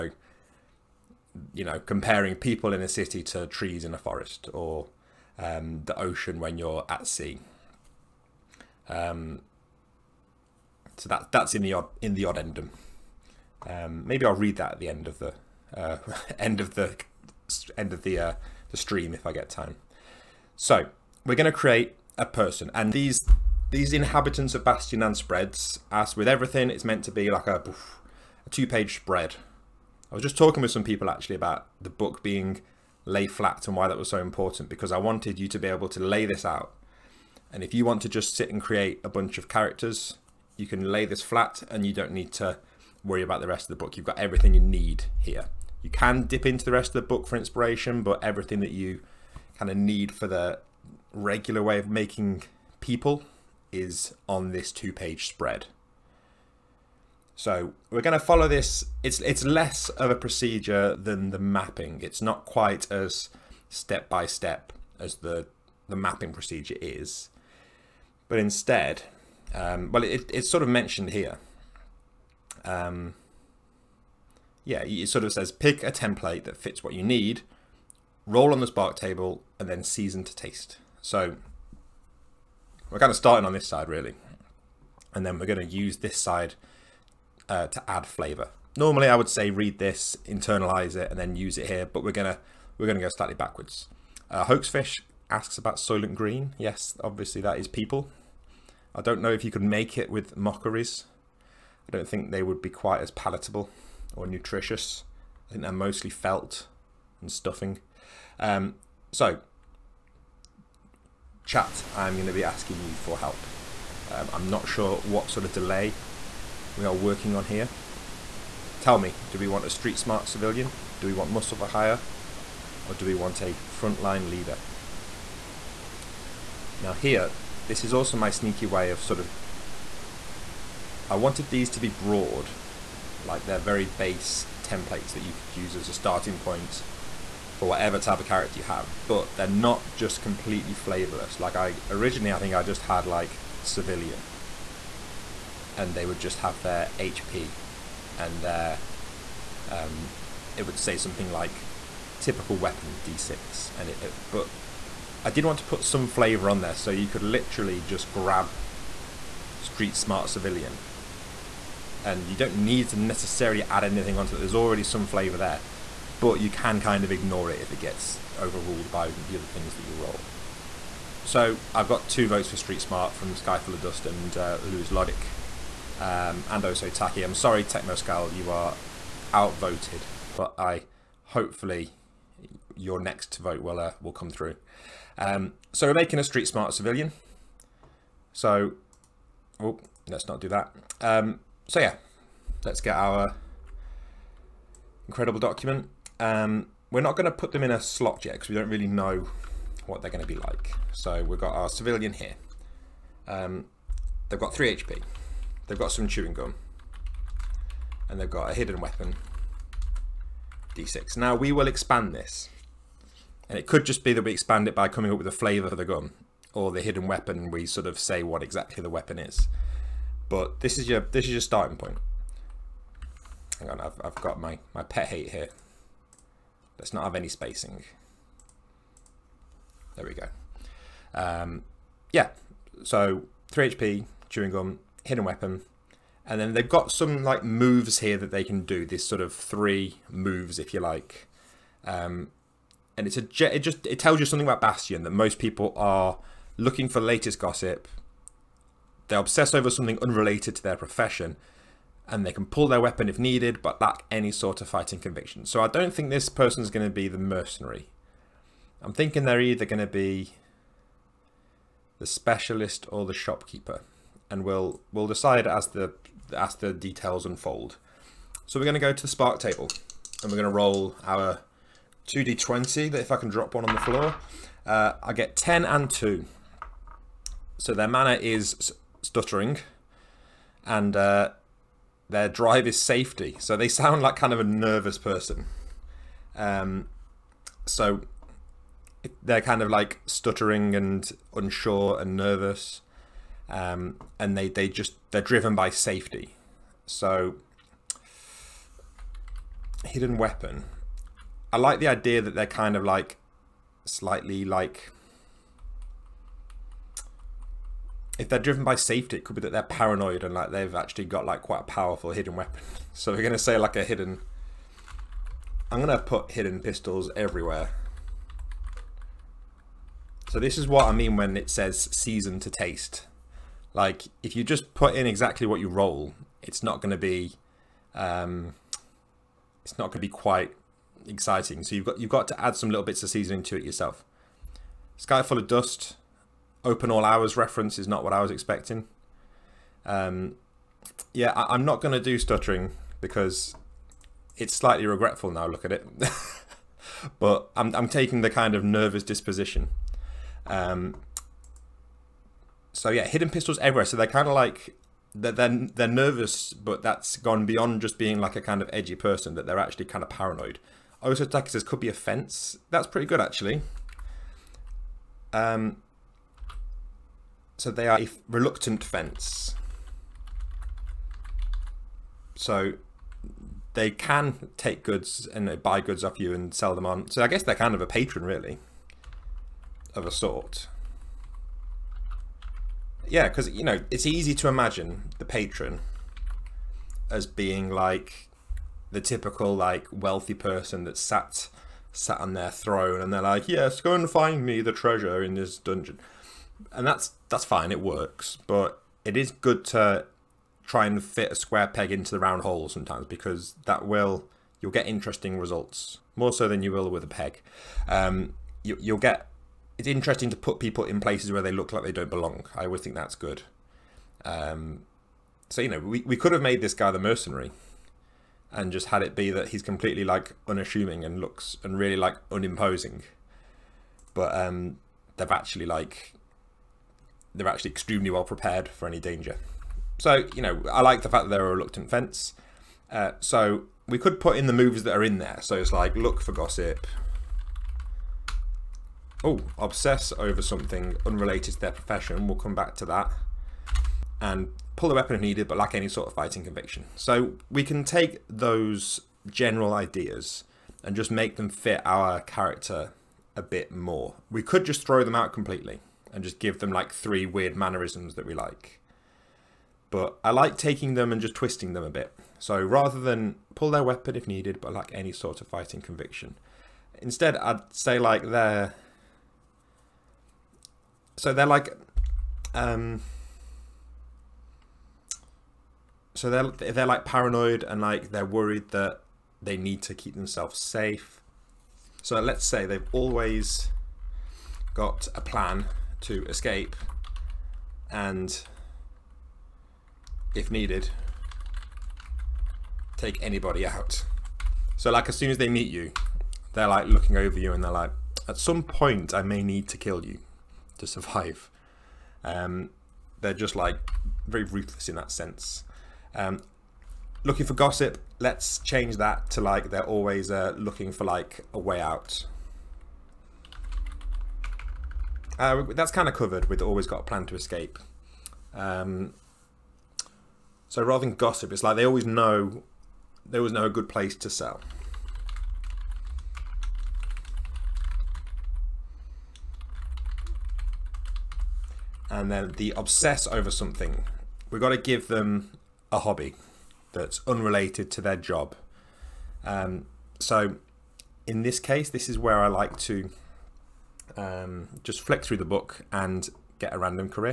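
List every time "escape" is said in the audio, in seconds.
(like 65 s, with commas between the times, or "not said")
486 s, 517 s.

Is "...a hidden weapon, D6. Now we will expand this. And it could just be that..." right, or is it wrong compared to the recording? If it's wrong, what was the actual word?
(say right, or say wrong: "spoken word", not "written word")
right.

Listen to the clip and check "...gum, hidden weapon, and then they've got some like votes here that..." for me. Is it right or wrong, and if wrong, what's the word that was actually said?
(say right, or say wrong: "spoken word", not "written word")
wrong: "moves", not "votes".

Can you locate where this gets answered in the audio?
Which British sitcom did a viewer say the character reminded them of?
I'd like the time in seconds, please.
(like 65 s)
336 s.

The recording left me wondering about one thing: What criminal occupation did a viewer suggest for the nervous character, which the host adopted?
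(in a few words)
A fence.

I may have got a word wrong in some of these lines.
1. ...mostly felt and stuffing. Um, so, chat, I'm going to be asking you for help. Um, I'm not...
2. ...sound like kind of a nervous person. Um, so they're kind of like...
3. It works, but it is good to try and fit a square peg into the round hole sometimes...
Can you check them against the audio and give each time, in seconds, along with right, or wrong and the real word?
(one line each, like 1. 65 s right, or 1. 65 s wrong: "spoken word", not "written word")
1. 105 s right
2. 283 s right
3. 397 s right.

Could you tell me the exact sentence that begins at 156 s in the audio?
So you could literally just grab street smart civilian and you don't need to necessarily add anything onto it.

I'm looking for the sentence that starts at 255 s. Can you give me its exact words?
So I don't think this person's going to be the mercenary.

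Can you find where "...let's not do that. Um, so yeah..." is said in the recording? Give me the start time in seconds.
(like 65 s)
190 s.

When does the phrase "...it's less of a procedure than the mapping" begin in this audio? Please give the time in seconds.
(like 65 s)
59 s.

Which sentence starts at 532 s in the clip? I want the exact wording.
And then the obsess over something.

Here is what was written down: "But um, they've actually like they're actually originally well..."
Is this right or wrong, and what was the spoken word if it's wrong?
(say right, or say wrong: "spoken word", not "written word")
wrong: "extremely", not "originally".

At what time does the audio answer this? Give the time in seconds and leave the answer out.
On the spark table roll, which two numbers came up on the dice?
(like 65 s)
275 s.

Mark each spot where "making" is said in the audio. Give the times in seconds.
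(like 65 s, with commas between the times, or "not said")
51 s, 185 s.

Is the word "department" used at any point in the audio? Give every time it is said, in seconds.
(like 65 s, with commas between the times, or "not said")
not said.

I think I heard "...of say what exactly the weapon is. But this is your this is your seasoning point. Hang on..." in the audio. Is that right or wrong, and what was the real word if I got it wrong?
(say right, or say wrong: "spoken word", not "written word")
wrong: "starting", not "seasoning".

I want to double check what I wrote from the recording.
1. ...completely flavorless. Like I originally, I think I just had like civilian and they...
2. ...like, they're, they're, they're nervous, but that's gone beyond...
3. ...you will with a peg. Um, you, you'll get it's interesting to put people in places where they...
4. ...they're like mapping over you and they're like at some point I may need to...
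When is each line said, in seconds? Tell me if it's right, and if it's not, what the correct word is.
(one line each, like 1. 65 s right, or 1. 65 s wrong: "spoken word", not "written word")
1. 140 s right
2. 354 s right
3. 406 s right
4. 496 s wrong: "looking", not "mapping".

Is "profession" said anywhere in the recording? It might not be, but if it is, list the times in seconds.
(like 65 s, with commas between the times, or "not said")
250 s, 441 s.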